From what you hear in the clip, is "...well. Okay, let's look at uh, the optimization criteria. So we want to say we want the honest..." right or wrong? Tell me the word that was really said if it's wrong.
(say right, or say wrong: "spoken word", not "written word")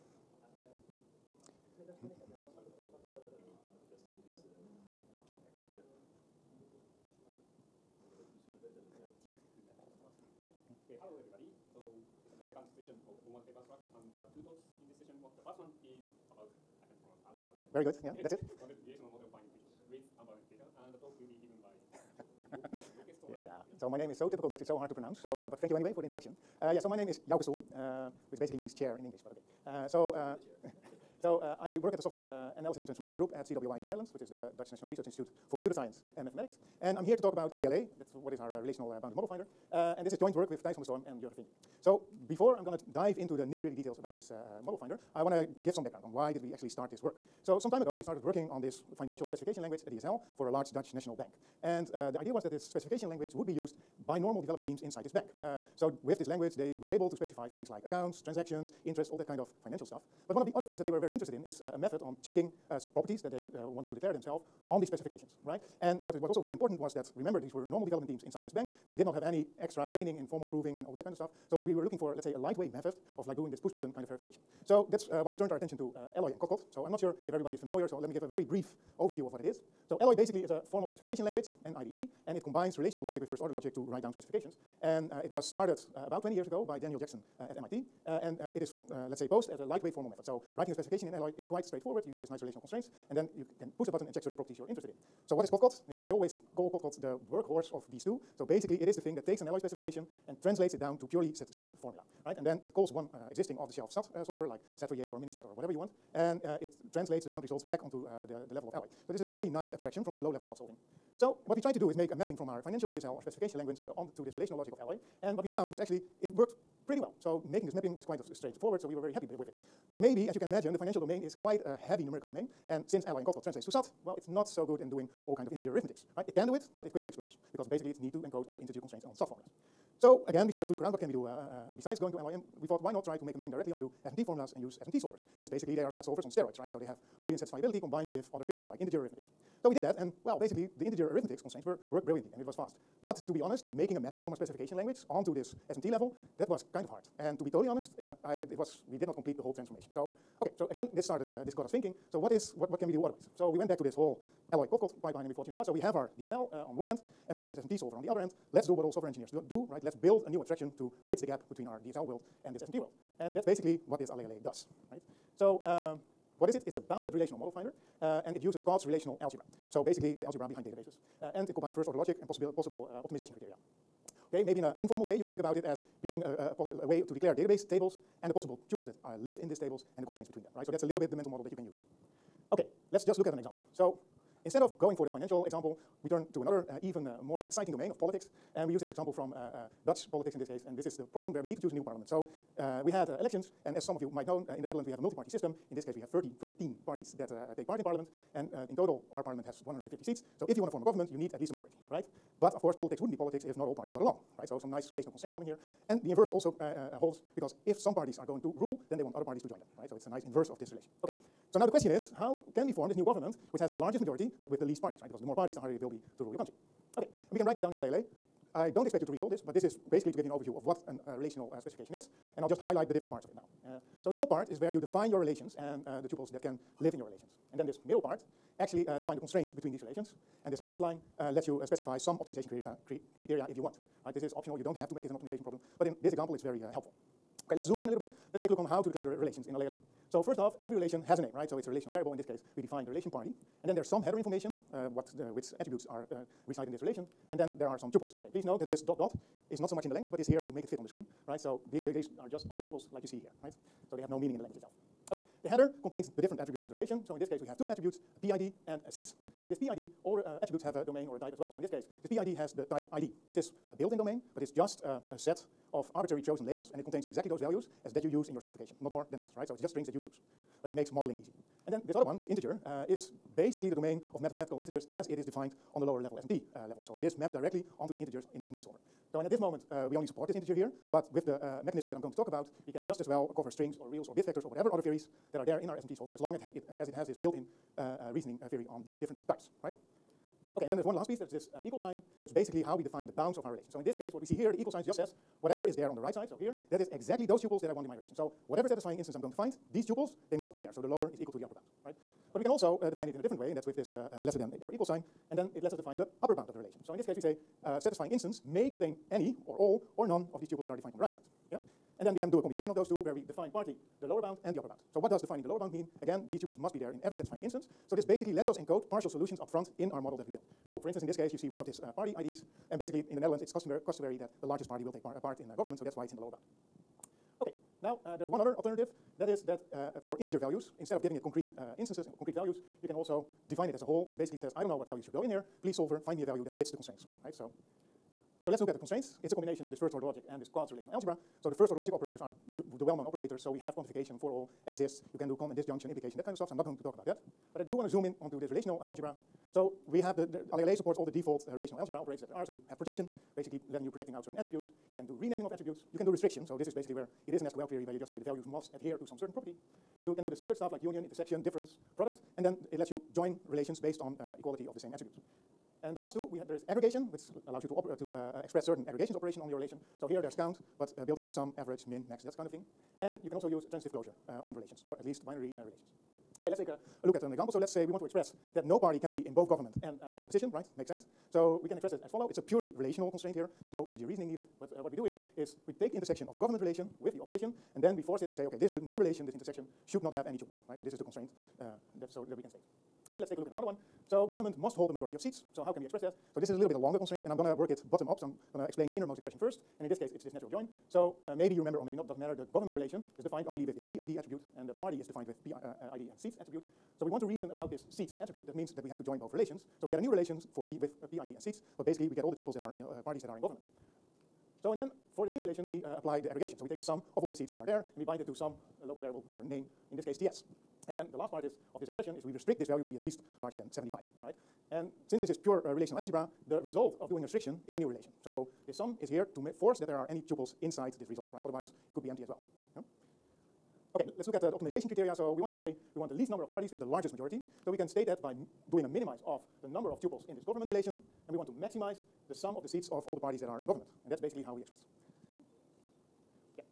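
wrong: "least", not "honest".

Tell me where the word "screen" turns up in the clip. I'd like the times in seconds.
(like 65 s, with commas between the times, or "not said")
250 s.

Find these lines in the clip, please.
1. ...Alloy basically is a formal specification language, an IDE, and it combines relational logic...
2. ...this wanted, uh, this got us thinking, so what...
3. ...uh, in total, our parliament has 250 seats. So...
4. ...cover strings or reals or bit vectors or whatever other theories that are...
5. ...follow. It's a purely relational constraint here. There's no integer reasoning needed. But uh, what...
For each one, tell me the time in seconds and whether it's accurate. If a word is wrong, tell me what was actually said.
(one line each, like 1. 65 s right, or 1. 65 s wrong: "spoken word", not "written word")
1. 79 s right
2. 150 s wrong: "started", not "wanted"
3. 198 s wrong: "150", not "250"
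4. 283 s right
5. 382 s right.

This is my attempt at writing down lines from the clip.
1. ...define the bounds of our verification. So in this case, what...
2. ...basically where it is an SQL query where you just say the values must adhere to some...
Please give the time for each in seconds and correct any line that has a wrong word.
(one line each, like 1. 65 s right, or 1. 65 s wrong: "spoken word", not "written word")
1. 292 s wrong: "relation", not "verification"
2. 356 s right.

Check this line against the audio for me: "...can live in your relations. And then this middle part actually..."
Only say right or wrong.
right.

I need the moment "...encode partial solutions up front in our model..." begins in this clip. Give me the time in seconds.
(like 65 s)
318 s.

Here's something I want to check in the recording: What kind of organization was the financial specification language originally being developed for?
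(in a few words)
A large Dutch national bank.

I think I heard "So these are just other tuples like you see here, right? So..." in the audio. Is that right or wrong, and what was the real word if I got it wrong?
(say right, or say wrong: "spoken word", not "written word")
right.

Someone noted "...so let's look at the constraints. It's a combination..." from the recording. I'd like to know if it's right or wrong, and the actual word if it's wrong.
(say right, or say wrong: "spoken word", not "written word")
right.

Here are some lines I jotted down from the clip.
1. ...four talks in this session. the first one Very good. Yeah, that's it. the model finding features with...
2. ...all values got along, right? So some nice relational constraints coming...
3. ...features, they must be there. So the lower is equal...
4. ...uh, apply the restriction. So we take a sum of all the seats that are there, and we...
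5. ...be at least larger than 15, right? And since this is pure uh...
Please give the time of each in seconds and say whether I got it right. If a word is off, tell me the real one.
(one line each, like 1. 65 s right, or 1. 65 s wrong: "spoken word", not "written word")
1. 14 s wrong: "two", not "four"
2. 203 s wrong: "parties", not "values"
3. 299 s wrong: "tuples", not "features"
4. 415 s wrong: "aggregation", not "restriction"
5. 422 s wrong: "75", not "15".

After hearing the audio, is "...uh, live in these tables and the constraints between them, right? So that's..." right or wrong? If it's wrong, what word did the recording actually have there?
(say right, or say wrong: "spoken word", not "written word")
right.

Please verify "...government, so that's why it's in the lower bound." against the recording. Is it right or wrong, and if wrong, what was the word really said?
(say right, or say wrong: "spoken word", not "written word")
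right.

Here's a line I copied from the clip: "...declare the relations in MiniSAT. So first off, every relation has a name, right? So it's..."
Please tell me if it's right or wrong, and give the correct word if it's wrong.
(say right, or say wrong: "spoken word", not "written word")
wrong: "AlleAlle", not "MiniSAT".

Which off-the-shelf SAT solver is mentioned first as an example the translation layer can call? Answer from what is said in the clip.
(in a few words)
SAT4J.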